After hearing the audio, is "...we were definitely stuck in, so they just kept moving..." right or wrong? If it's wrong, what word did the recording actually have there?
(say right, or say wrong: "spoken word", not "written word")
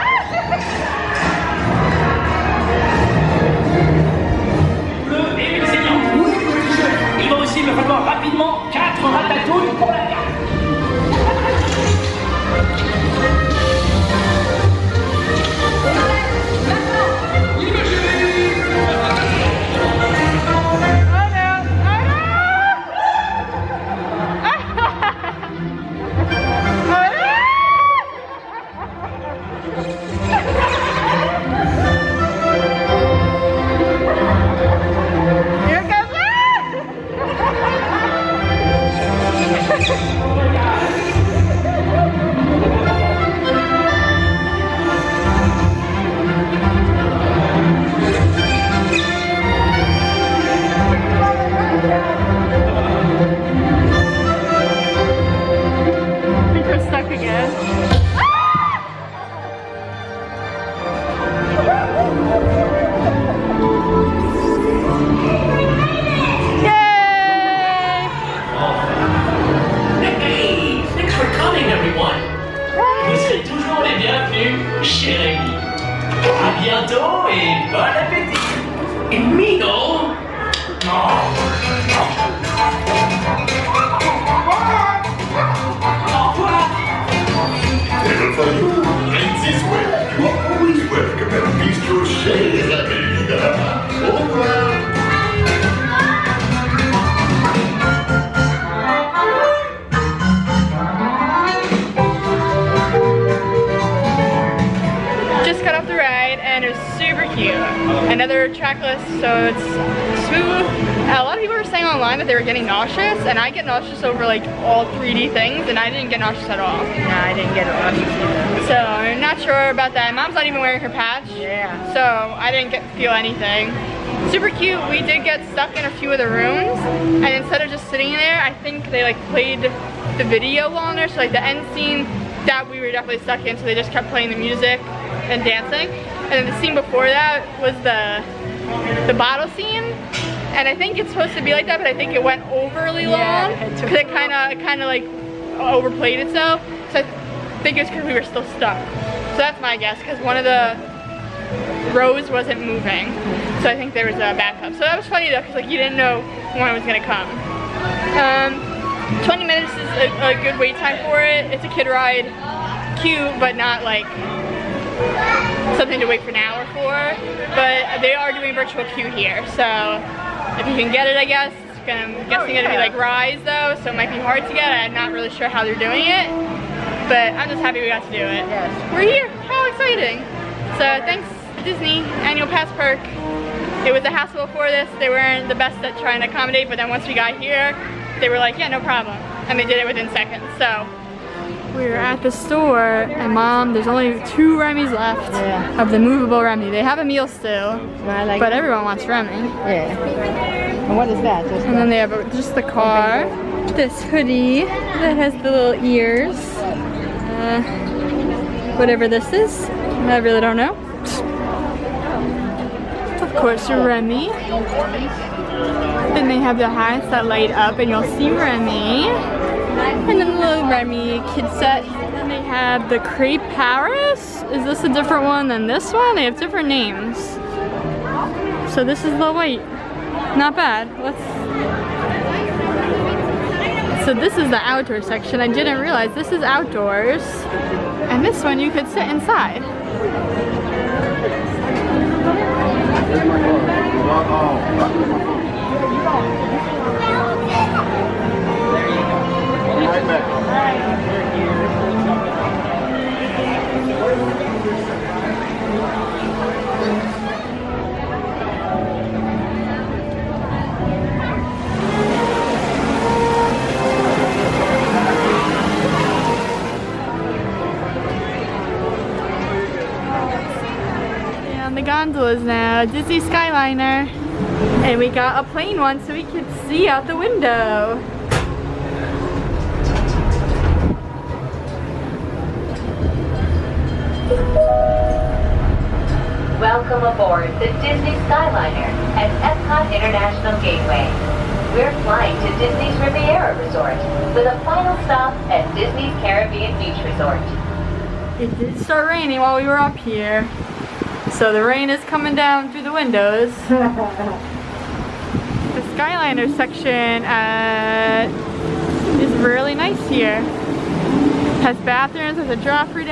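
wrong: "playing", not "moving".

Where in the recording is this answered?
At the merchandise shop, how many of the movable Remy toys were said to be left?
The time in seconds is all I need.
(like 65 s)
194 s.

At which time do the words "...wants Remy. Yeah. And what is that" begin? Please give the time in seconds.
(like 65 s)
198 s.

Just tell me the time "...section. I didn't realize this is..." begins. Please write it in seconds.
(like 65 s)
235 s.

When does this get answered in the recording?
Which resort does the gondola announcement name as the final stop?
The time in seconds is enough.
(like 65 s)
295 s.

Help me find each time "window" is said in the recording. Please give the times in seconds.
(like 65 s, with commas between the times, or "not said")
277 s, 302 s.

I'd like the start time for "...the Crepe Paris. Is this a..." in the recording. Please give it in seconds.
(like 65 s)
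222 s.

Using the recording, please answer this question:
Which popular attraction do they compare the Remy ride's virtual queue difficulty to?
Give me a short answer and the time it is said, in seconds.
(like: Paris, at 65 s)
Rise, at 172 s.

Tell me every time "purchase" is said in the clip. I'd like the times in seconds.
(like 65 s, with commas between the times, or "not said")
not said.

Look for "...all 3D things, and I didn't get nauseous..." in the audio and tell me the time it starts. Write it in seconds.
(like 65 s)
114 s.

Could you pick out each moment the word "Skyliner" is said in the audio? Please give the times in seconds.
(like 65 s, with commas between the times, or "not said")
273 s, 288 s, 305 s.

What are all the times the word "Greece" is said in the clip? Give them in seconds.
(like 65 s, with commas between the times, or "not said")
not said.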